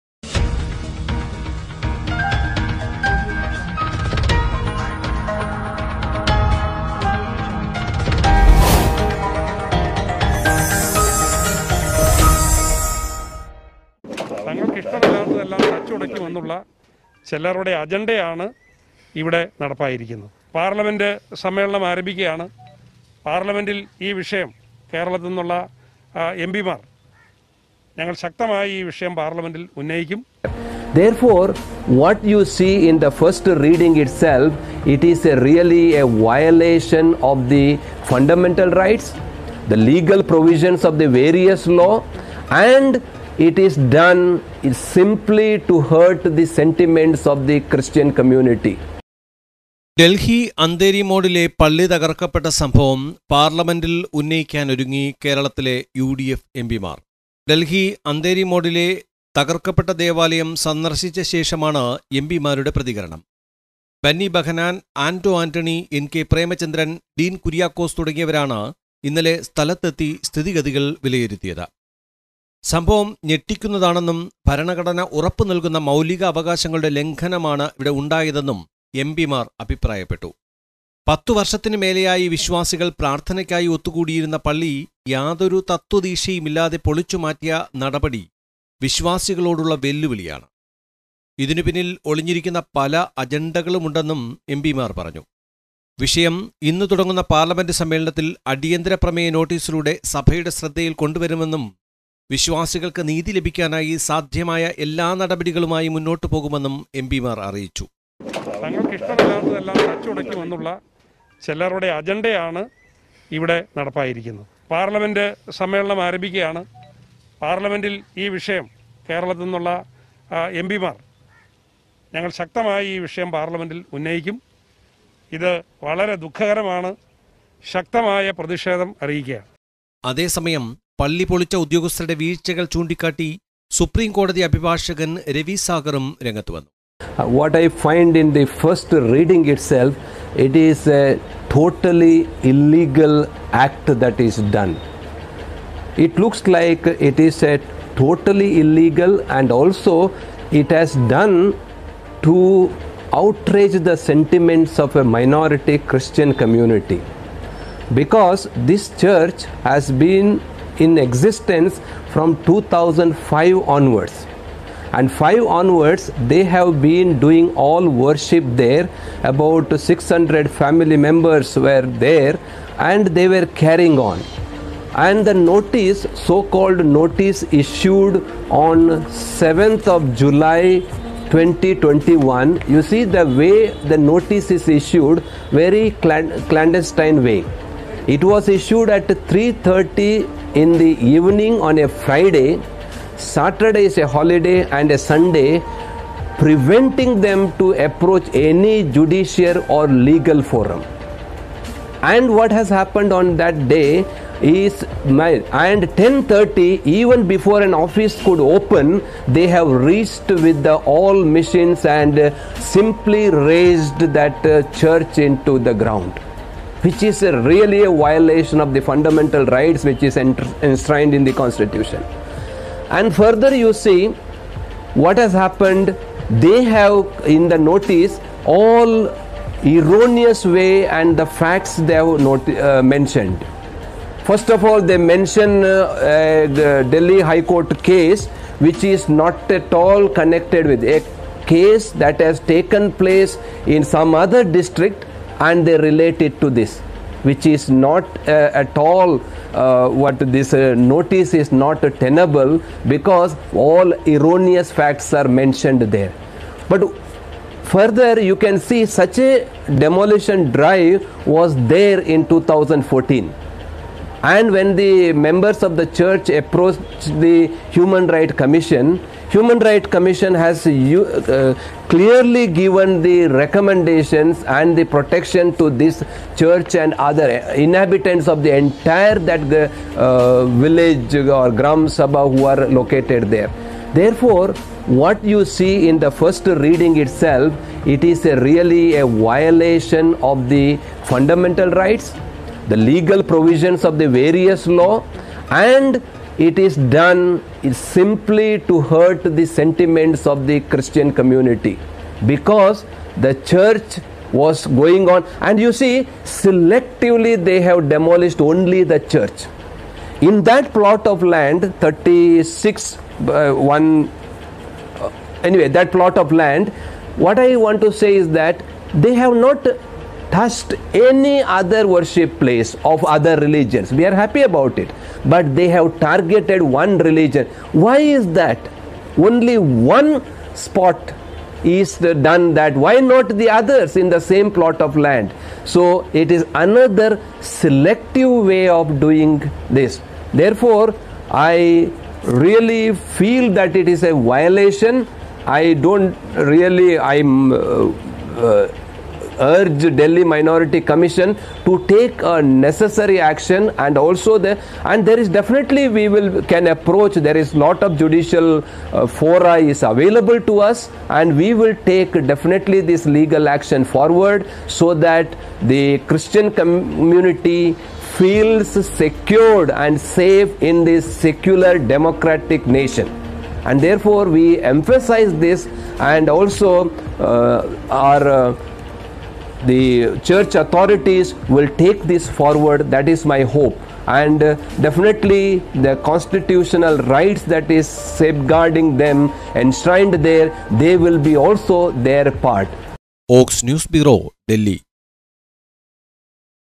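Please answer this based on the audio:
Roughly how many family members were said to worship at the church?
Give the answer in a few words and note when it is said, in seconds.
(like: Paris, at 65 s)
600, at 169 s.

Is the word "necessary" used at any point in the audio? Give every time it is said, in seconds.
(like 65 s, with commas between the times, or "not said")
352 s.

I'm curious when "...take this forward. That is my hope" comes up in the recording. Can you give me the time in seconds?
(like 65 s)
381 s.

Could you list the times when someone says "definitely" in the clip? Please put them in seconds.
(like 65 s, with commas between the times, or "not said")
355 s, 362 s, 384 s.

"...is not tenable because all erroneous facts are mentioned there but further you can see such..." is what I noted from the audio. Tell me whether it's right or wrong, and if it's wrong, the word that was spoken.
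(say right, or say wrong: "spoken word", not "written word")
right.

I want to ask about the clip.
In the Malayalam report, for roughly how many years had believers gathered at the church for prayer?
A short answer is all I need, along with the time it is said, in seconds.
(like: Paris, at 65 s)
10, at 81 s.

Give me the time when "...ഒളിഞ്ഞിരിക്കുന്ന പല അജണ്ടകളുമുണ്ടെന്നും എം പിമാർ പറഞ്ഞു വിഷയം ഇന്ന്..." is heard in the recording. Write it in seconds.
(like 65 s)
92 s.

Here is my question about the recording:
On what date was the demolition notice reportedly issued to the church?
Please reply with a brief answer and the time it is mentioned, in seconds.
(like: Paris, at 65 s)
7 July 2021, at 179 s.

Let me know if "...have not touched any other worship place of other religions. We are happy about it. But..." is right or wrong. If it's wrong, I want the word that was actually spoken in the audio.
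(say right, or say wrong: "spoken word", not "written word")
right.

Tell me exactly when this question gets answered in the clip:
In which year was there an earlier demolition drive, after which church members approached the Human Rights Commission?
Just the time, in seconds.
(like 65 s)
262 s.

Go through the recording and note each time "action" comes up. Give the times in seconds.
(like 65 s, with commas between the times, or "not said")
353 s, 363 s.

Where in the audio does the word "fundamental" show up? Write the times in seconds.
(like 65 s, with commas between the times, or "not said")
38 s, 218 s, 291 s.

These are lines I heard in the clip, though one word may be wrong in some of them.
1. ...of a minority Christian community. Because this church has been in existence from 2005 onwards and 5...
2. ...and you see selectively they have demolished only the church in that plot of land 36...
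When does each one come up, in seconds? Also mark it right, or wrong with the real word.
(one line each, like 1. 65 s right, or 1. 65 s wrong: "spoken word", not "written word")
1. 154 s right
2. 305 s right.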